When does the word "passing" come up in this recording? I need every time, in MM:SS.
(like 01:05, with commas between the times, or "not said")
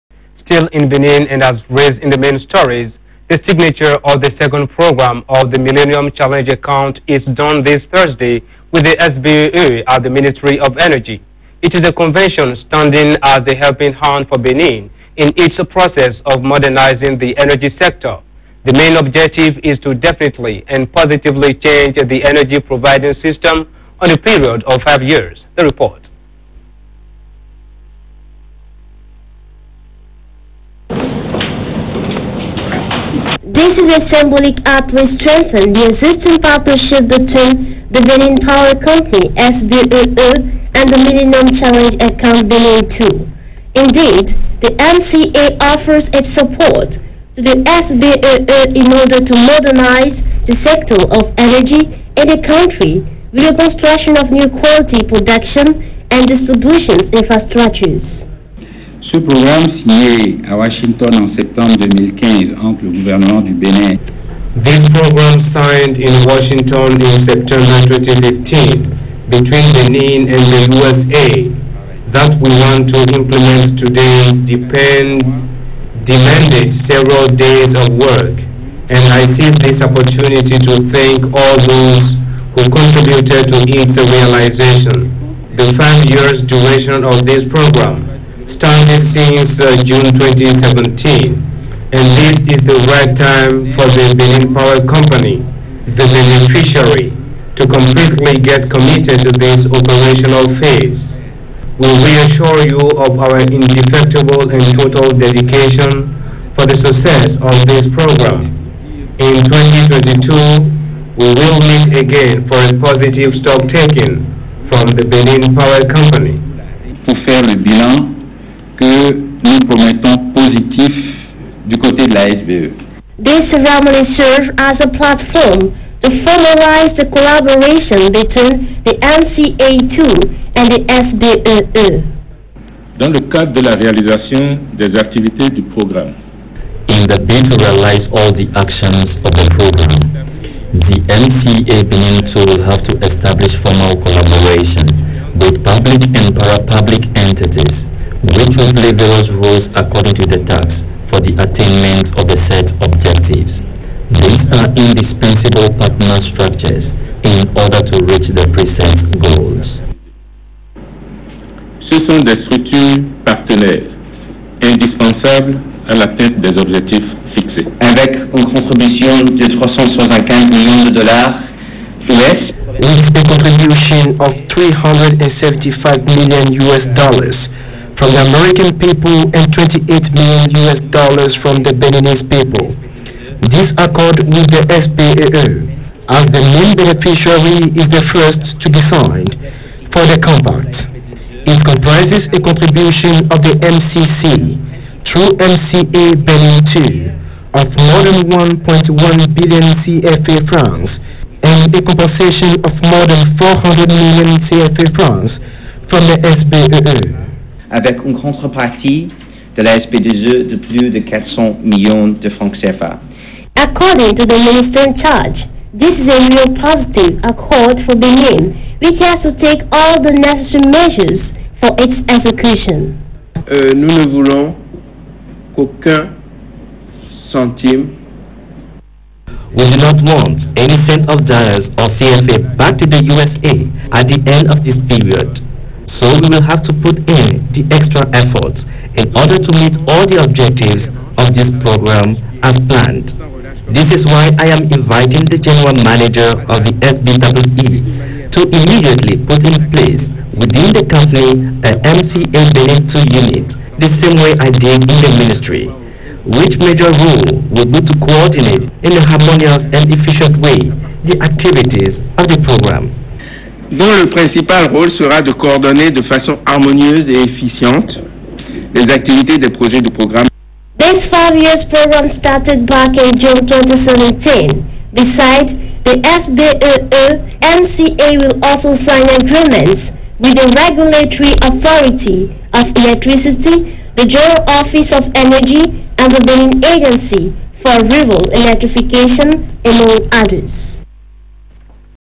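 not said.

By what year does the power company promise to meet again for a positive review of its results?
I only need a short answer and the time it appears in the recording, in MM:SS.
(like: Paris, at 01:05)
2022, at 01:49.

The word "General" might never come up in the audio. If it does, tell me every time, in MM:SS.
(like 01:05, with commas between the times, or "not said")
04:05, 04:44.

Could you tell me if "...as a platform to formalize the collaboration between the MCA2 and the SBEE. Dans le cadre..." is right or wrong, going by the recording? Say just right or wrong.
right.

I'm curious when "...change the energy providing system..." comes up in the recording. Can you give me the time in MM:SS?
00:21.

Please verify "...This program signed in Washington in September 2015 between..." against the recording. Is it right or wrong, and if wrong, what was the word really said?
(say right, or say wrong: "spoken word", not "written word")
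right.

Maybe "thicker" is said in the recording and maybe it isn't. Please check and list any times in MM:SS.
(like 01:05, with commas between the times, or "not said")
not said.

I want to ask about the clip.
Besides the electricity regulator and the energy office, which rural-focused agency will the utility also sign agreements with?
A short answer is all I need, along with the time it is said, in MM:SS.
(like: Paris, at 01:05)
Benin Agency for Rural Electrification, at 04:46.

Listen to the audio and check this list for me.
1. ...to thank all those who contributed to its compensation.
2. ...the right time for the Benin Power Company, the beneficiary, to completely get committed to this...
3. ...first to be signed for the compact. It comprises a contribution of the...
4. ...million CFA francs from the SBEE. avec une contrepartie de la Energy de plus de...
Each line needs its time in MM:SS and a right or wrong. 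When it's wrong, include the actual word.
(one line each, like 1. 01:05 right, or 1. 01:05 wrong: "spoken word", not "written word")
1. 01:20 wrong: "realization", not "compensation"
2. 01:32 right
3. 03:08 right
4. 03:23 wrong: "SPDE", not "Energy".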